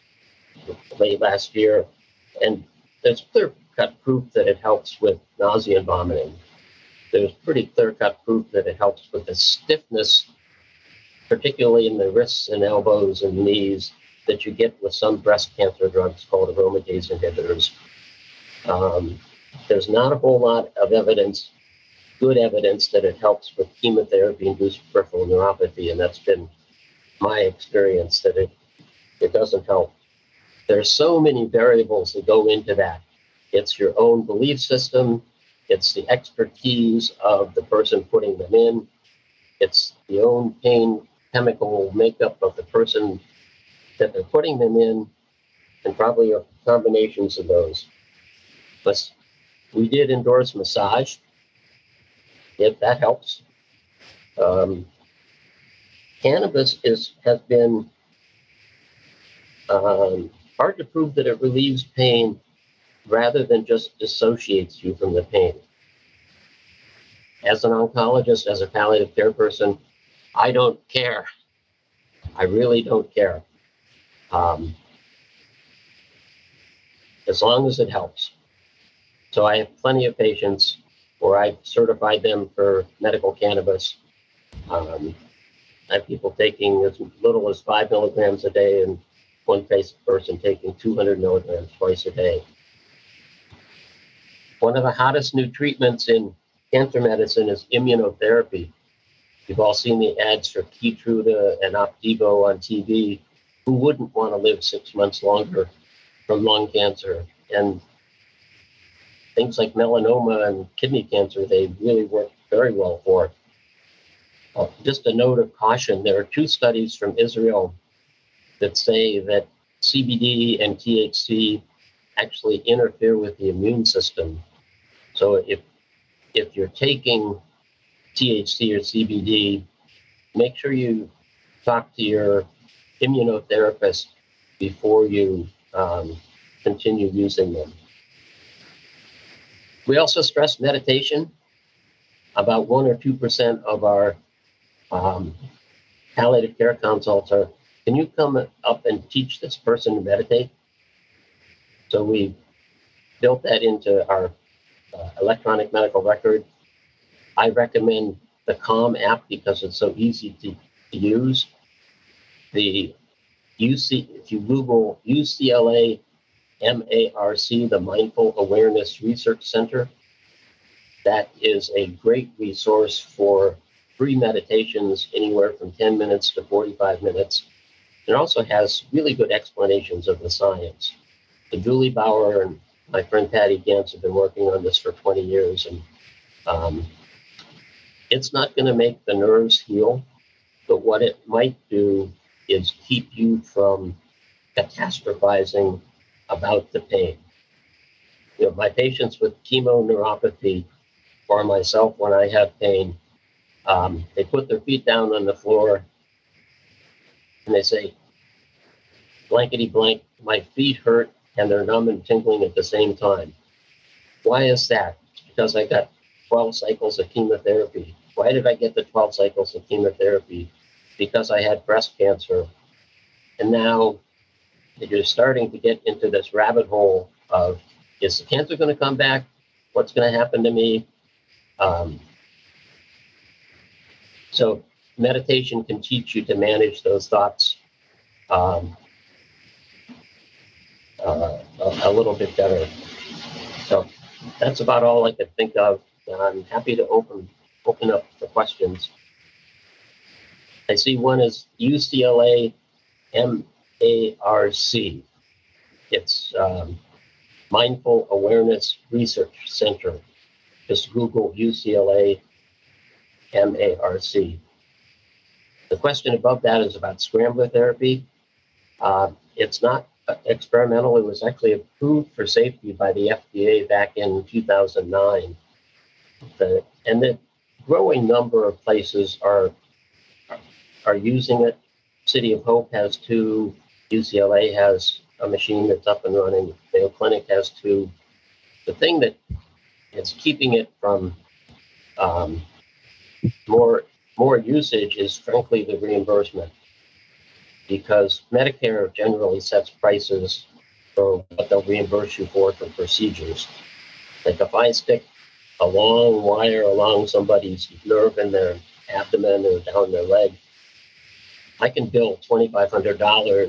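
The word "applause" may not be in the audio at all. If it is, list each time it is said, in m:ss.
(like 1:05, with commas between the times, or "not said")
not said.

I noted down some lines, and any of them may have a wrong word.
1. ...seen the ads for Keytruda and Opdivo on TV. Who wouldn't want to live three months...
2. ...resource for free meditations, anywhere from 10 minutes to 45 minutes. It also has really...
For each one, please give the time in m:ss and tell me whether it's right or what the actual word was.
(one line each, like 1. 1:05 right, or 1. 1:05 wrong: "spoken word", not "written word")
1. 1:39 wrong: "six", not "three"
2. 2:52 right.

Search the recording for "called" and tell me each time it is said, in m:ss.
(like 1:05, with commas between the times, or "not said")
0:16.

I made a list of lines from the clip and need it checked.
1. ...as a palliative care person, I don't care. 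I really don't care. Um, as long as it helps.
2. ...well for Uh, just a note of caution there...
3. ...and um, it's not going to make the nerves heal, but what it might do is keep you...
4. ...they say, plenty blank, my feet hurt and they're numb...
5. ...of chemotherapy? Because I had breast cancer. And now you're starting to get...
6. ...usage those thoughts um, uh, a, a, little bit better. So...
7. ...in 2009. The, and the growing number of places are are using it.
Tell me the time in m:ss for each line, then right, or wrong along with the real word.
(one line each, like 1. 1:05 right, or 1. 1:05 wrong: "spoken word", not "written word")
1. 1:08 right
2. 1:52 right
3. 3:05 right
4. 3:27 wrong: "blankety", not "plenty"
5. 3:39 right
6. 3:56 wrong: "manage", not "usage"
7. 4:33 right.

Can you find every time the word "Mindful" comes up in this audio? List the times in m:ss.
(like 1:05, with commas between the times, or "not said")
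2:47, 4:17.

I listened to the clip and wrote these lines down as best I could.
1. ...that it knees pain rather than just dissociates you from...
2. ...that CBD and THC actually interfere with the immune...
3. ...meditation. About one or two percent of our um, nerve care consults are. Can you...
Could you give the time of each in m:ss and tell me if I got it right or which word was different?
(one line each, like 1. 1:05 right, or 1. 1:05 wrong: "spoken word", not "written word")
1. 1:01 wrong: "relieves", not "knees"
2. 1:59 right
3. 2:20 wrong: "palliative", not "nerve".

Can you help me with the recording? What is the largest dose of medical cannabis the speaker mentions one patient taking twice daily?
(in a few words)
200 milligrams.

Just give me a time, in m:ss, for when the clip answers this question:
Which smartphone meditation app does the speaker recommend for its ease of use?
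2:38.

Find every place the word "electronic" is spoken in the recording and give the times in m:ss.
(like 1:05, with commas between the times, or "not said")
2:35.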